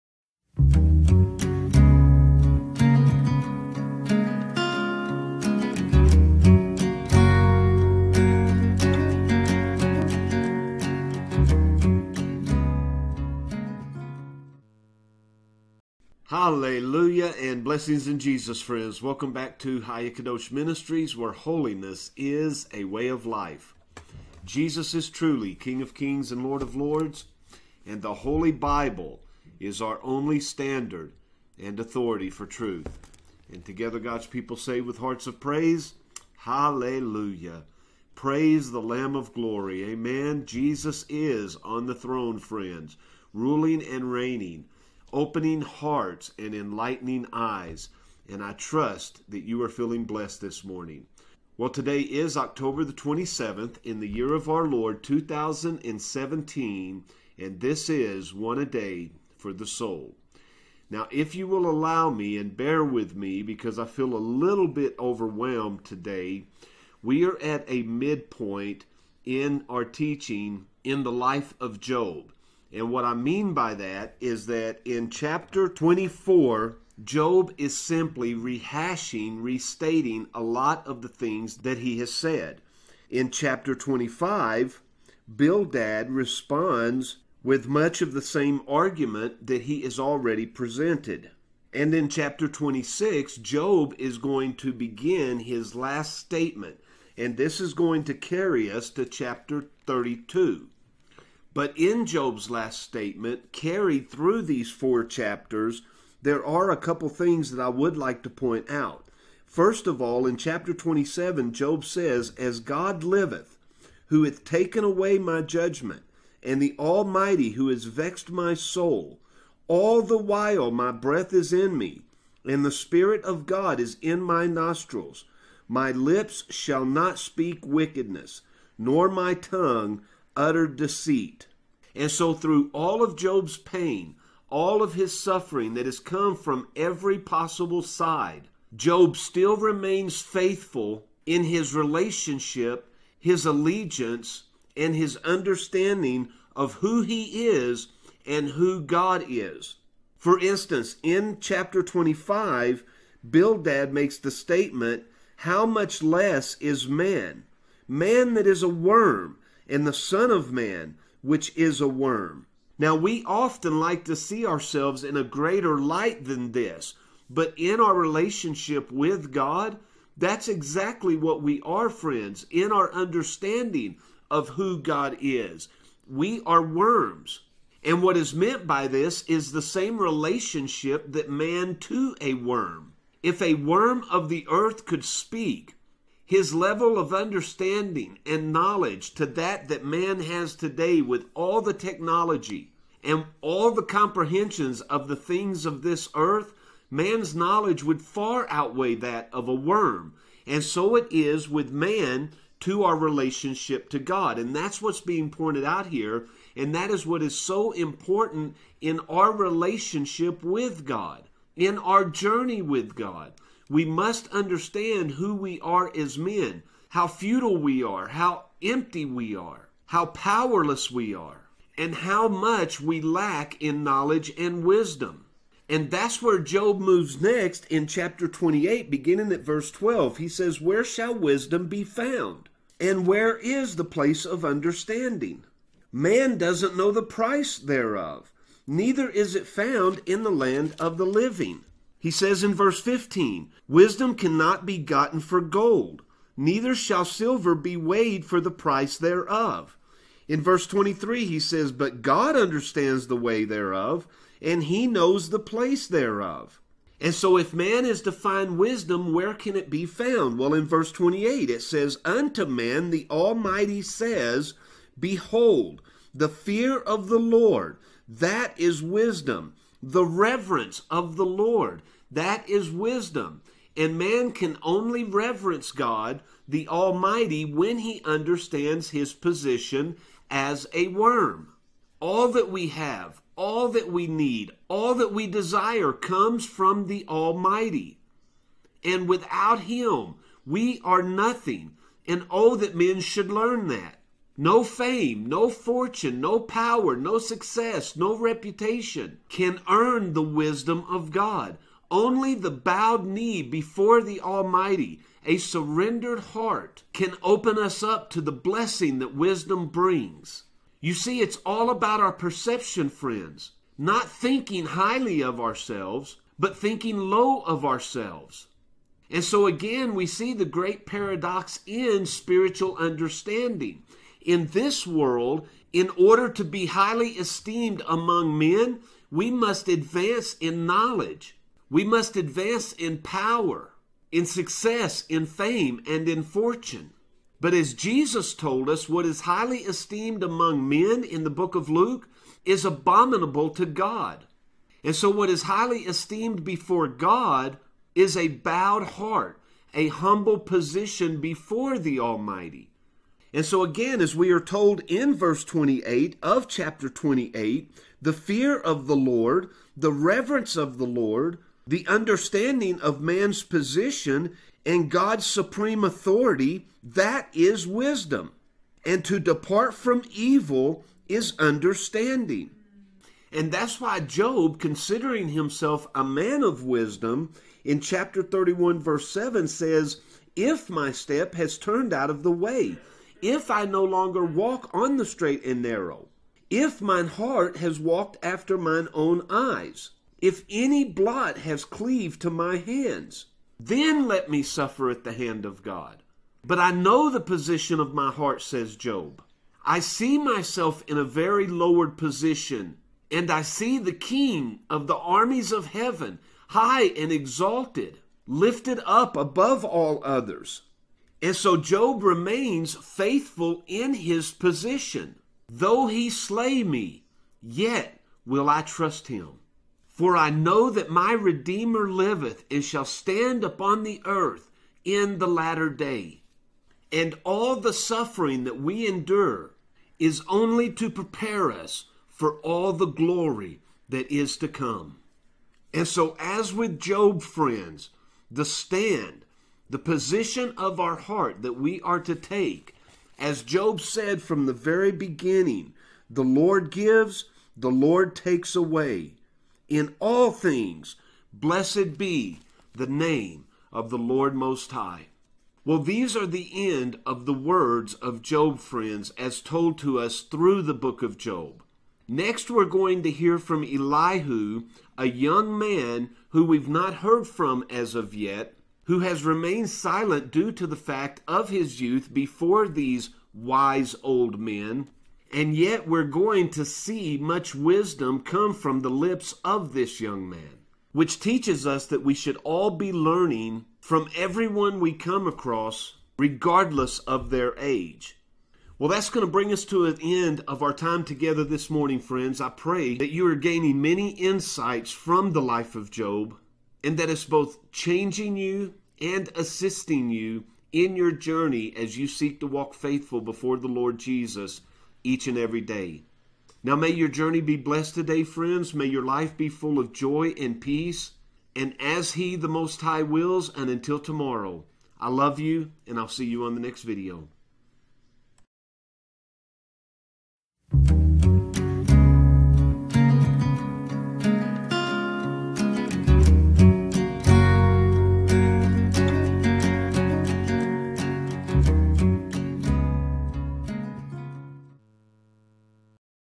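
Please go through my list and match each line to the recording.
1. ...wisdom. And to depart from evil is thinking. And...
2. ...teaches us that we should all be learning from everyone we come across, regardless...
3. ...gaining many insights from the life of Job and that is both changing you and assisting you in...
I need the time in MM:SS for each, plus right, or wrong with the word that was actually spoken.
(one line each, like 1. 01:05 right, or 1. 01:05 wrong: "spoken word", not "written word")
1. 06:07 wrong: "understanding", not "thinking"
2. 08:01 right
3. 08:13 right.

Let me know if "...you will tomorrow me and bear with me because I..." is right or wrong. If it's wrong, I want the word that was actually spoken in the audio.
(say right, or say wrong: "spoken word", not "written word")
wrong: "allow", not "tomorrow".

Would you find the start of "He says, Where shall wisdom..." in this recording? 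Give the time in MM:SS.
03:50.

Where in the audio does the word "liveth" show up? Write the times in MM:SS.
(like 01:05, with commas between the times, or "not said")
01:53, 07:01.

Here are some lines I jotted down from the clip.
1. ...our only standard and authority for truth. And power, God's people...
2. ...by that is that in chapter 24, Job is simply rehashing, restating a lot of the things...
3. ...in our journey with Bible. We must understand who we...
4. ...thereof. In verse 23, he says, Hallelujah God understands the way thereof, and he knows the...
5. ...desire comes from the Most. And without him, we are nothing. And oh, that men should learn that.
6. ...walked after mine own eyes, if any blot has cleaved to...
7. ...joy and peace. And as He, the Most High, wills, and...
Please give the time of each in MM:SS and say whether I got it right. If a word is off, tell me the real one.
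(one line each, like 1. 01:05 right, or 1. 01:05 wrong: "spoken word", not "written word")
1. 00:29 wrong: "together", not "power"
2. 01:13 right
3. 03:31 wrong: "God", not "Bible"
4. 04:08 wrong: "But", not "Hallelujah"
5. 04:45 wrong: "Almighty", not "Most"
6. 06:27 right
7. 08:29 right.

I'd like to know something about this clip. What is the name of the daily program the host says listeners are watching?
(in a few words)
One a Day for the Soul.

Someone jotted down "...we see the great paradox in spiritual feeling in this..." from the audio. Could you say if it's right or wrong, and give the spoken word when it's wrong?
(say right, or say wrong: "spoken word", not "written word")
wrong: "understanding", not "feeling".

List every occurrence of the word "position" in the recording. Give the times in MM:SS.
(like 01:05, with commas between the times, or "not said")
04:39, 05:50, 06:03, 06:37, 06:41, 06:54, 07:19.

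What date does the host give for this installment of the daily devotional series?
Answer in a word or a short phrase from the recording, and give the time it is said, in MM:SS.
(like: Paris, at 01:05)
October 27, 2017, at 00:52.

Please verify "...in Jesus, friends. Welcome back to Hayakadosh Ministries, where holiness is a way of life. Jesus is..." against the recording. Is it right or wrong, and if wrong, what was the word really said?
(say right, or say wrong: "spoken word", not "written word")
right.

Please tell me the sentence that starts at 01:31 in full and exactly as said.
And in chapter 26, Job is going to begin his last statement.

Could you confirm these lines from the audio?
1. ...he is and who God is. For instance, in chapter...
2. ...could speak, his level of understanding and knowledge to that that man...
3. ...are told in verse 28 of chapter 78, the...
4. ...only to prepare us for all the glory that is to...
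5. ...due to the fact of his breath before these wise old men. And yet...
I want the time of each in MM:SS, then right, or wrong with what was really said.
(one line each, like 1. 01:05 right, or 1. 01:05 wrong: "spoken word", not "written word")
1. 02:27 right
2. 03:04 right
3. 05:54 wrong: "28", not "78"
4. 07:10 right
5. 07:50 wrong: "youth", not "breath".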